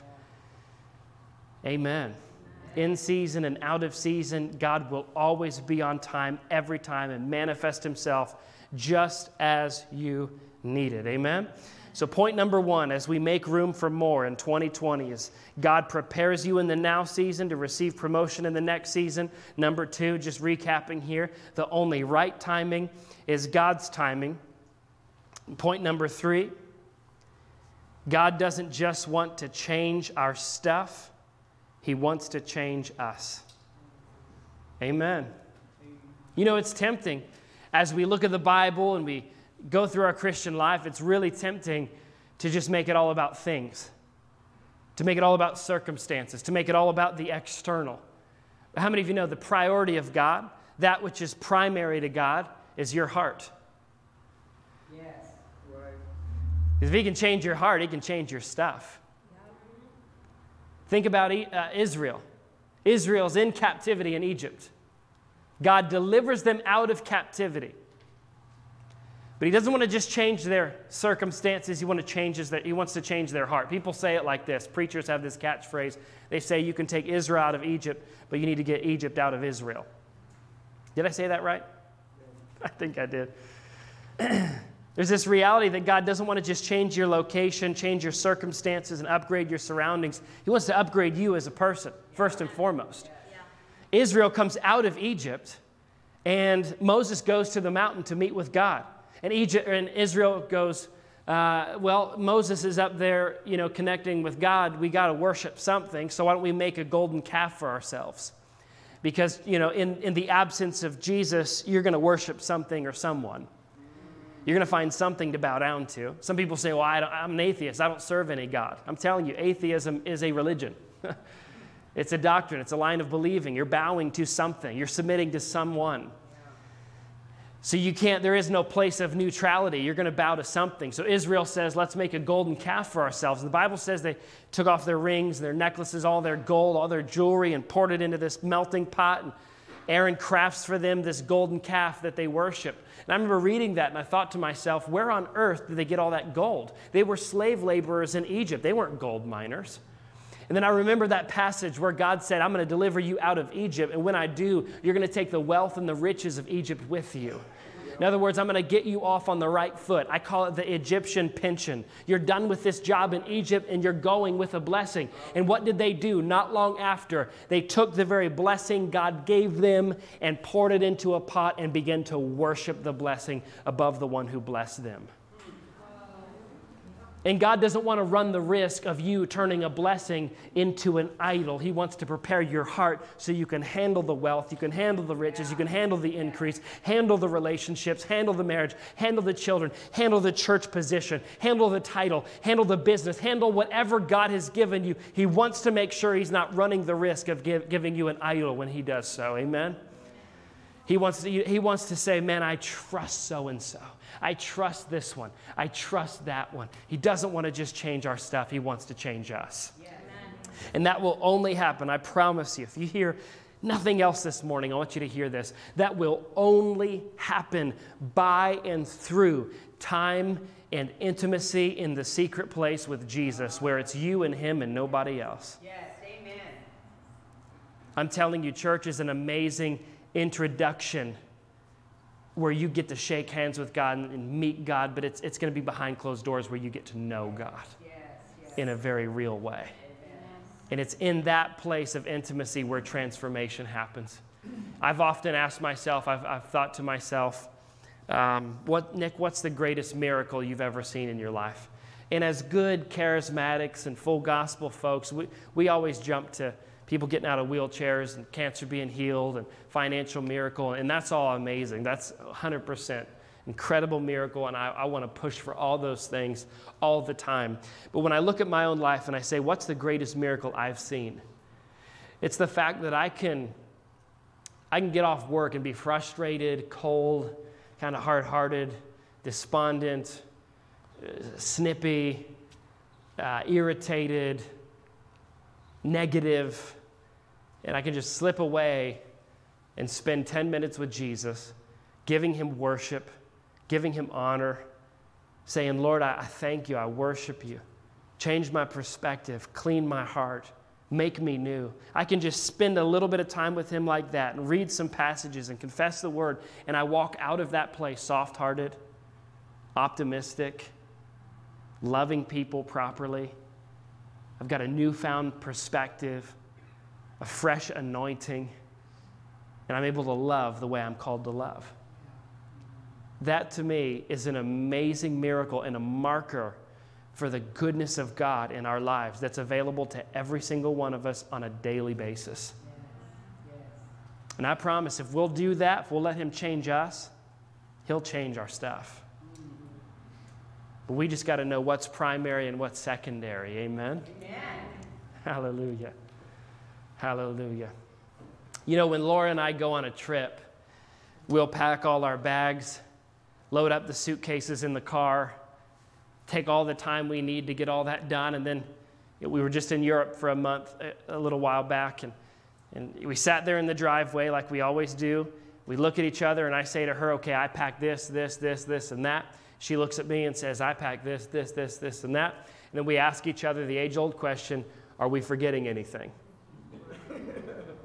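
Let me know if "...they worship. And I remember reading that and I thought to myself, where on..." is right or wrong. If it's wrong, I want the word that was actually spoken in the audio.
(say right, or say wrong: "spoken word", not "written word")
right.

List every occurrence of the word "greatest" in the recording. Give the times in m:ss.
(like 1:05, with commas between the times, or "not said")
4:09, 4:29.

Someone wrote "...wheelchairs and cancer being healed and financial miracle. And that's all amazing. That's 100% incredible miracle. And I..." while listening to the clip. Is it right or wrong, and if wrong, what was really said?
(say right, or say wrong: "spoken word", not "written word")
right.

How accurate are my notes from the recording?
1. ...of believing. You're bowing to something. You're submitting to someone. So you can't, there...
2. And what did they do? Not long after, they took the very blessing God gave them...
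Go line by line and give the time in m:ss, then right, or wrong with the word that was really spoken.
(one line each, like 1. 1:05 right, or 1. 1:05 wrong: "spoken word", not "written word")
1. 2:02 right
2. 2:45 right.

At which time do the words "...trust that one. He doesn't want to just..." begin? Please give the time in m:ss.
3:25.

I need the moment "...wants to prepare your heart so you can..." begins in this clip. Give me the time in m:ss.
3:01.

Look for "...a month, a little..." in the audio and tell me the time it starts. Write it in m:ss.
6:00.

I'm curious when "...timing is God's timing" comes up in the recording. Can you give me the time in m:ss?
0:22.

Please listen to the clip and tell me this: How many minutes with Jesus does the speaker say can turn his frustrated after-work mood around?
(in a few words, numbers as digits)
10.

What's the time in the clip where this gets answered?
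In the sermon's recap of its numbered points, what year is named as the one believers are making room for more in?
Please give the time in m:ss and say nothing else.
0:14.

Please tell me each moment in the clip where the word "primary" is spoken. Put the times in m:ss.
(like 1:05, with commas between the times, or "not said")
0:51, 5:41.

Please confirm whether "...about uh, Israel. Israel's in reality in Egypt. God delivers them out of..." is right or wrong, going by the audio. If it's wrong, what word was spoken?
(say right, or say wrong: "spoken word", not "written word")
wrong: "captivity", not "reality".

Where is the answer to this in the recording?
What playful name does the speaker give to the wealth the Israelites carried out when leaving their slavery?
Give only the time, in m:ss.
2:40.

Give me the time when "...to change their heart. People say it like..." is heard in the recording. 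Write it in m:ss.
1:12.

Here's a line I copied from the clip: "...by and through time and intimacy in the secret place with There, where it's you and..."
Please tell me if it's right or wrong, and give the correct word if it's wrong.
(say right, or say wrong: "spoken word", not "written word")
wrong: "Jesus", not "There".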